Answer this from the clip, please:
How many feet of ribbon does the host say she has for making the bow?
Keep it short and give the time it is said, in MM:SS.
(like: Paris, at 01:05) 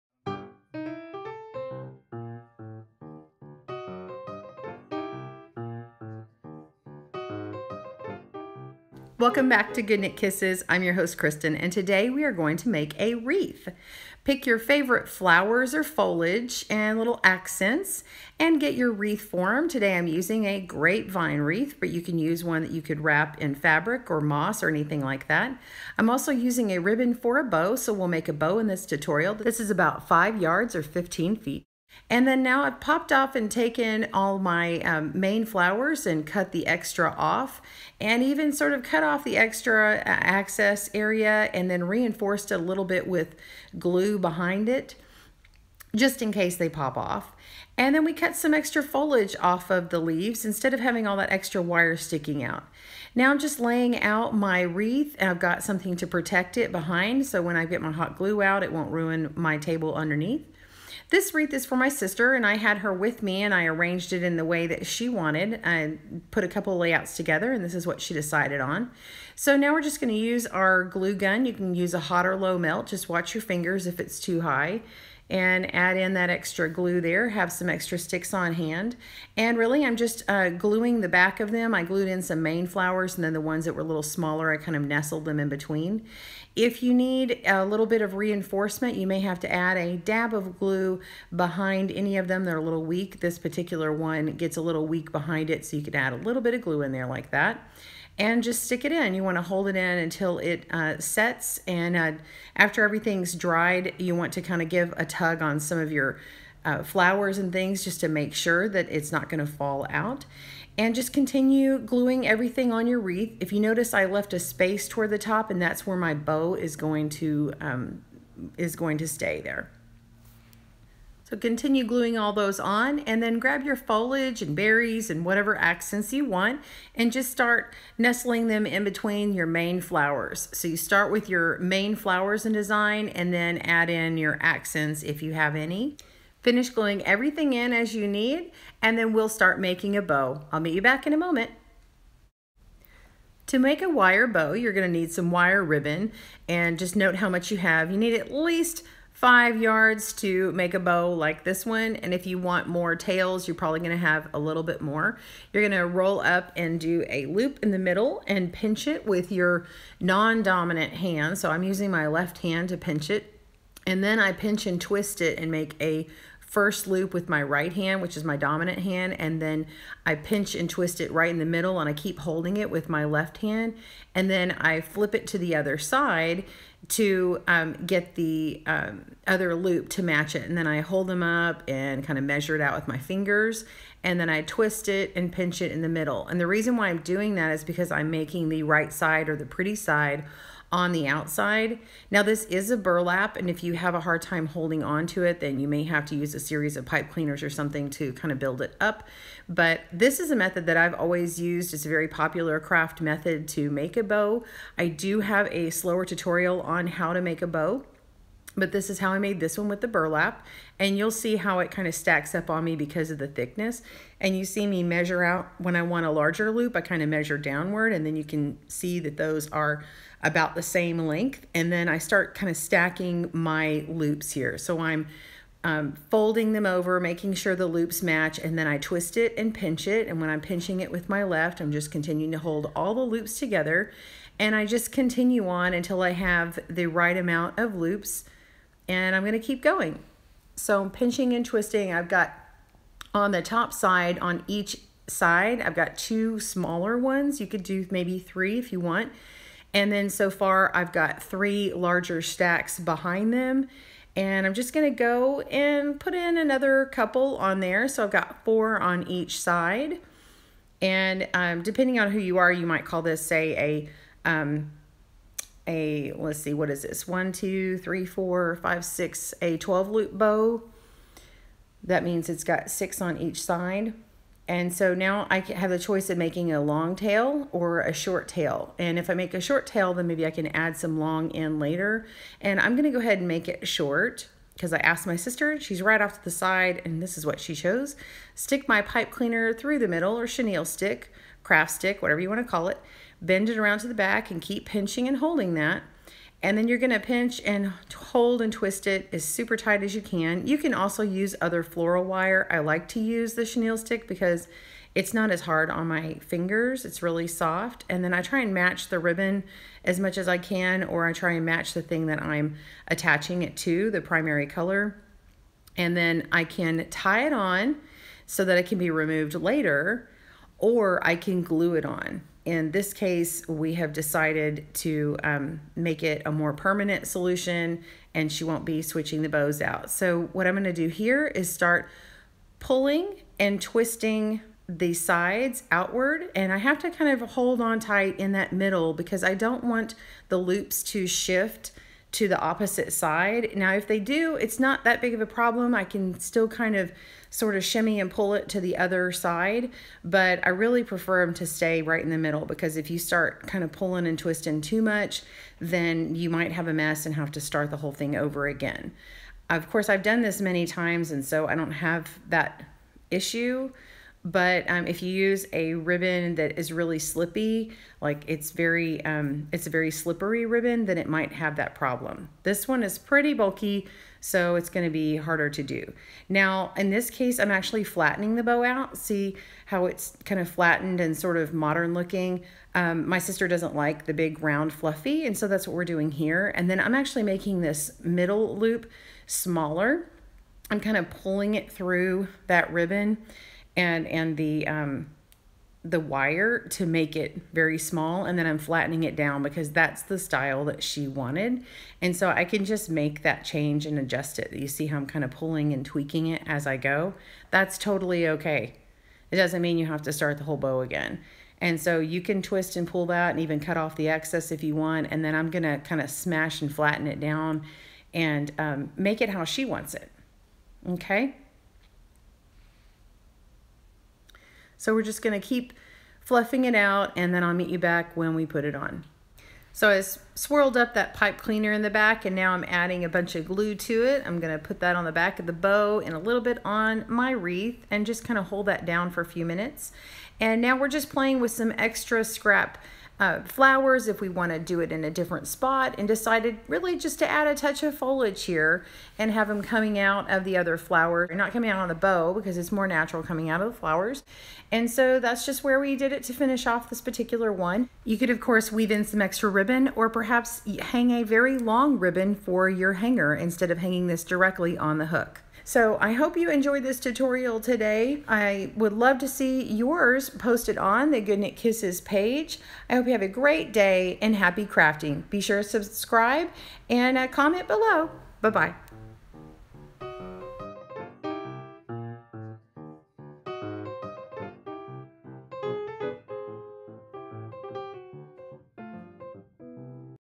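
15 feet, at 00:30.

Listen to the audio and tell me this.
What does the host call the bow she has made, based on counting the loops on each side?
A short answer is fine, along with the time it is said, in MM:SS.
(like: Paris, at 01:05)
12 loop bow, at 04:29.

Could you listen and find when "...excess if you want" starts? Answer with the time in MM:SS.
06:54.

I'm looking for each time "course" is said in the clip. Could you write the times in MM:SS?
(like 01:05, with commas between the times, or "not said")
05:59, 07:38.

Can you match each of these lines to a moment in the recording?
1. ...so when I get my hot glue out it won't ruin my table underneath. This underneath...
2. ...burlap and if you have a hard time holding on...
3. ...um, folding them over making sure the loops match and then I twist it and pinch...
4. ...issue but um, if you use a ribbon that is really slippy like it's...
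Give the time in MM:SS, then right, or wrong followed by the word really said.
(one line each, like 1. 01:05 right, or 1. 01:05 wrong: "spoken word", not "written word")
1. 00:57 wrong: "wreath", not "underneath"
2. 03:12 right
3. 03:45 right
4. 06:03 right.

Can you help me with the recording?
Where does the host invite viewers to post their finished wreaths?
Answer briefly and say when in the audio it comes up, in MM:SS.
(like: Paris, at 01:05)
Good Knit Kisses page, at 07:51.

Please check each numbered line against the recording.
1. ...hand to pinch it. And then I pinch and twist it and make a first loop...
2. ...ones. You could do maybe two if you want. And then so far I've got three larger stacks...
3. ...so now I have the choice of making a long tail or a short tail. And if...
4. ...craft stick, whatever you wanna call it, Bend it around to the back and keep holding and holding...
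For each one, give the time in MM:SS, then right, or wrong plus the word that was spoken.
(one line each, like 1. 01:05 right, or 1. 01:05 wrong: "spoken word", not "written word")
1. 02:42 right
2. 04:06 wrong: "three", not "two"
3. 04:34 right
4. 04:51 wrong: "pinching", not "holding".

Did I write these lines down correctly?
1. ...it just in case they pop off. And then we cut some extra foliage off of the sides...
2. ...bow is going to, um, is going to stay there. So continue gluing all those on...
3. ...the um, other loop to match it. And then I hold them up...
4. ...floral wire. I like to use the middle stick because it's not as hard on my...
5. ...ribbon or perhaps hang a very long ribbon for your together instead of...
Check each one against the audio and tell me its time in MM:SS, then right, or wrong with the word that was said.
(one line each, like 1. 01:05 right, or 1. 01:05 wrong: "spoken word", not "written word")
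1. 00:44 wrong: "leaves", not "sides"
2. 01:56 right
3. 02:58 right
4. 05:01 wrong: "chenille", not "middle"
5. 07:39 wrong: "hanger", not "together".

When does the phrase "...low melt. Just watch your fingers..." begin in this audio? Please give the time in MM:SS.
01:12.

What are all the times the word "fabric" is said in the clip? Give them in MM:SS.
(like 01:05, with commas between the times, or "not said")
00:23.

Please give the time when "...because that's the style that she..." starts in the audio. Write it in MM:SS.
06:39.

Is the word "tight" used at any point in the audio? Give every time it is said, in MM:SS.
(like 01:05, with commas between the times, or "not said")
04:59, 05:37.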